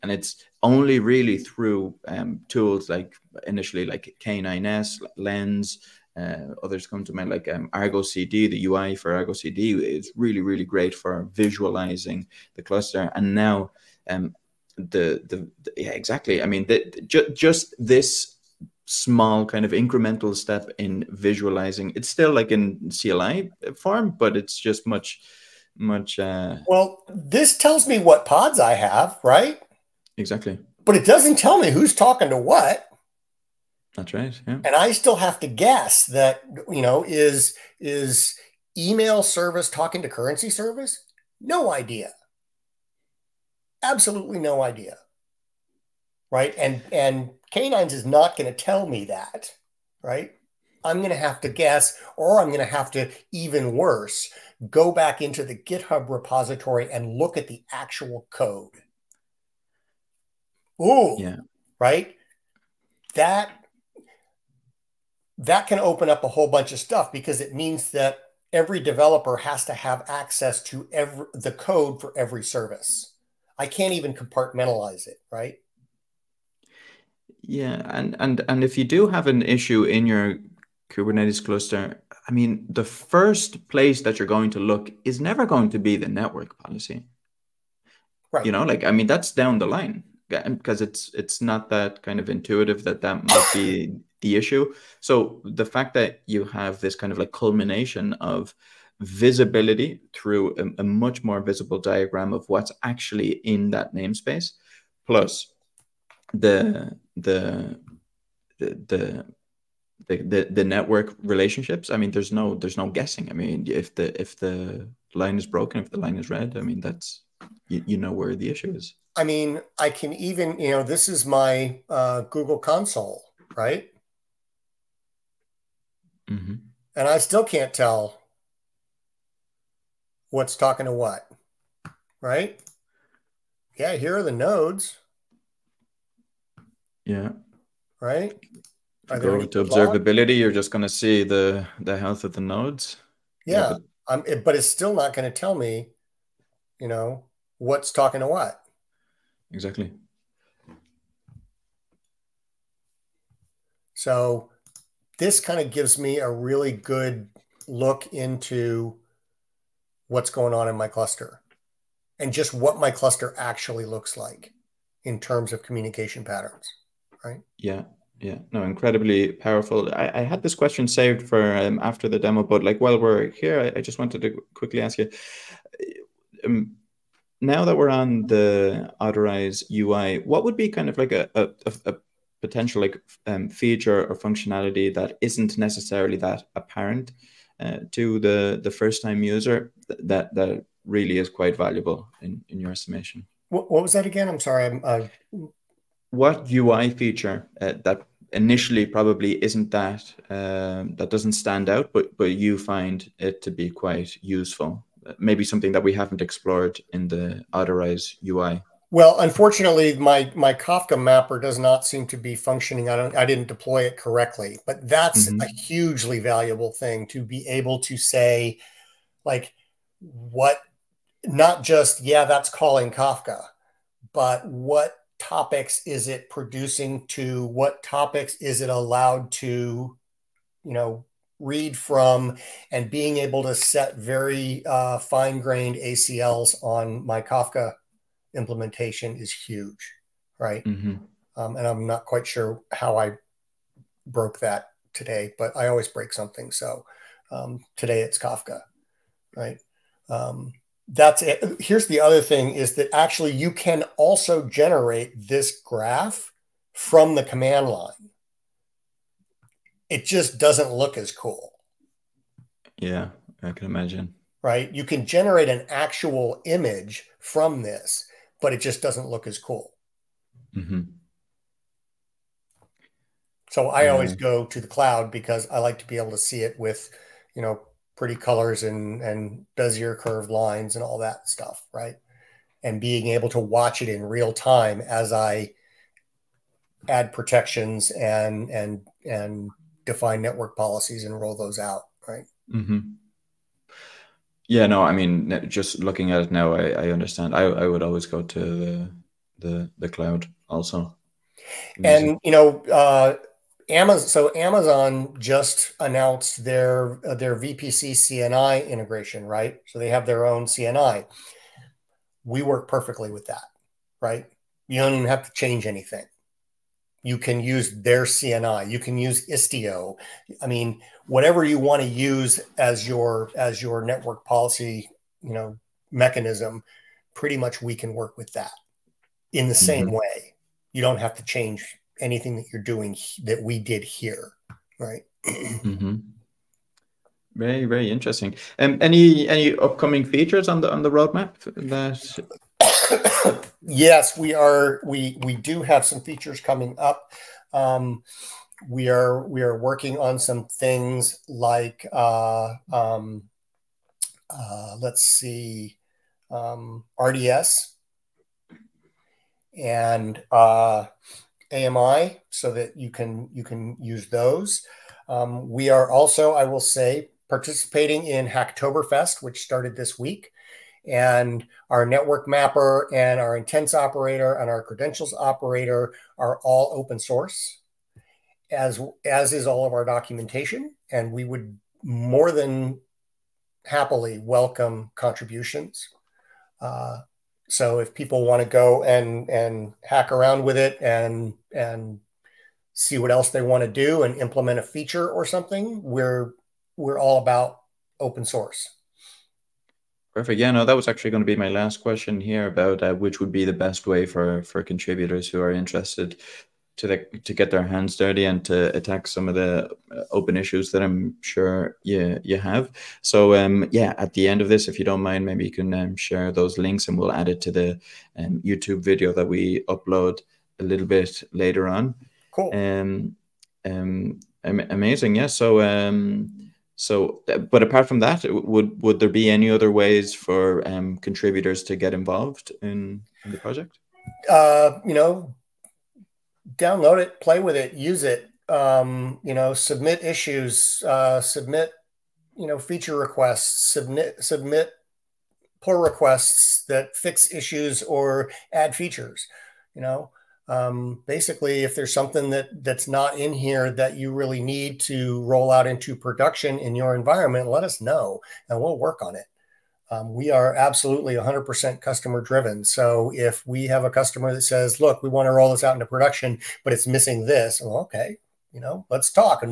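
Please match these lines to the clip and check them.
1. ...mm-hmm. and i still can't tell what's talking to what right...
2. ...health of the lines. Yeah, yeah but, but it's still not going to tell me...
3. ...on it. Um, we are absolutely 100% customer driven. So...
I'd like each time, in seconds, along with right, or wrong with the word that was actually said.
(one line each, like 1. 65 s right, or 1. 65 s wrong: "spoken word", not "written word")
1. 126 s right
2. 141 s wrong: "nodes", not "lines"
3. 459 s right.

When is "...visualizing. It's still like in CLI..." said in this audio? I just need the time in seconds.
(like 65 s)
21 s.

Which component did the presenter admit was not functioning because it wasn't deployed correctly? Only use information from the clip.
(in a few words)
Kafka mapper.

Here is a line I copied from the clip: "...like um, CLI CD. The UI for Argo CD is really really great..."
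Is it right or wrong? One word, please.
wrong.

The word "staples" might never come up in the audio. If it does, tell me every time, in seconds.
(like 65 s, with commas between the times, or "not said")
not said.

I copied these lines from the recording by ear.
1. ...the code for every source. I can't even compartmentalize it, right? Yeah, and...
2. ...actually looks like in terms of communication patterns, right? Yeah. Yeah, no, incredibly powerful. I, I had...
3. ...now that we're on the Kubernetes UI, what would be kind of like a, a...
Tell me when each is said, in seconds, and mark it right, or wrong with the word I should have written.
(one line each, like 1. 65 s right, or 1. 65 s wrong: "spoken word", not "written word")
1. 71 s wrong: "service", not "source"
2. 163 s right
3. 177 s wrong: "Otterize", not "Kubernetes".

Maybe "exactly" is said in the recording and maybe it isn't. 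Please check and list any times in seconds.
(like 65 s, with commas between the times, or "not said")
15 s, 30 s, 149 s.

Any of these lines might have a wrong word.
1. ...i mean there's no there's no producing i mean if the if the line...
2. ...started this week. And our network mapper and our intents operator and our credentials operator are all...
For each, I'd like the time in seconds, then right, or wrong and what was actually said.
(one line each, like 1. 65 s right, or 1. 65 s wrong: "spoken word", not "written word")
1. 111 s wrong: "guessing", not "producing"
2. 369 s right.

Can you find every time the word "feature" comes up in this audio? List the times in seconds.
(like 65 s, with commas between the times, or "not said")
183 s, 196 s, 340 s, 346 s, 394 s, 442 s, 448 s.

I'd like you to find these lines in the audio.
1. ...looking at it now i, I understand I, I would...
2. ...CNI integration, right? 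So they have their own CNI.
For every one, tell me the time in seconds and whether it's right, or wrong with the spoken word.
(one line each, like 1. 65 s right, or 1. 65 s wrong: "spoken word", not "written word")
1. 295 s right
2. 307 s right.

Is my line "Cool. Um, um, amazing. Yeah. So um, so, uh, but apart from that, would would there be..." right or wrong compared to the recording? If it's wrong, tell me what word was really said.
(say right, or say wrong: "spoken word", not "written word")
right.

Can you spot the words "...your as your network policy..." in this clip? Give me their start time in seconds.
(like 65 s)
322 s.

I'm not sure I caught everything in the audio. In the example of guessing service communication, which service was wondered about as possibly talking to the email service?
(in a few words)
currency service.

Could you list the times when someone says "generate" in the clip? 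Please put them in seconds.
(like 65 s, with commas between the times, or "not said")
254 s, 265 s.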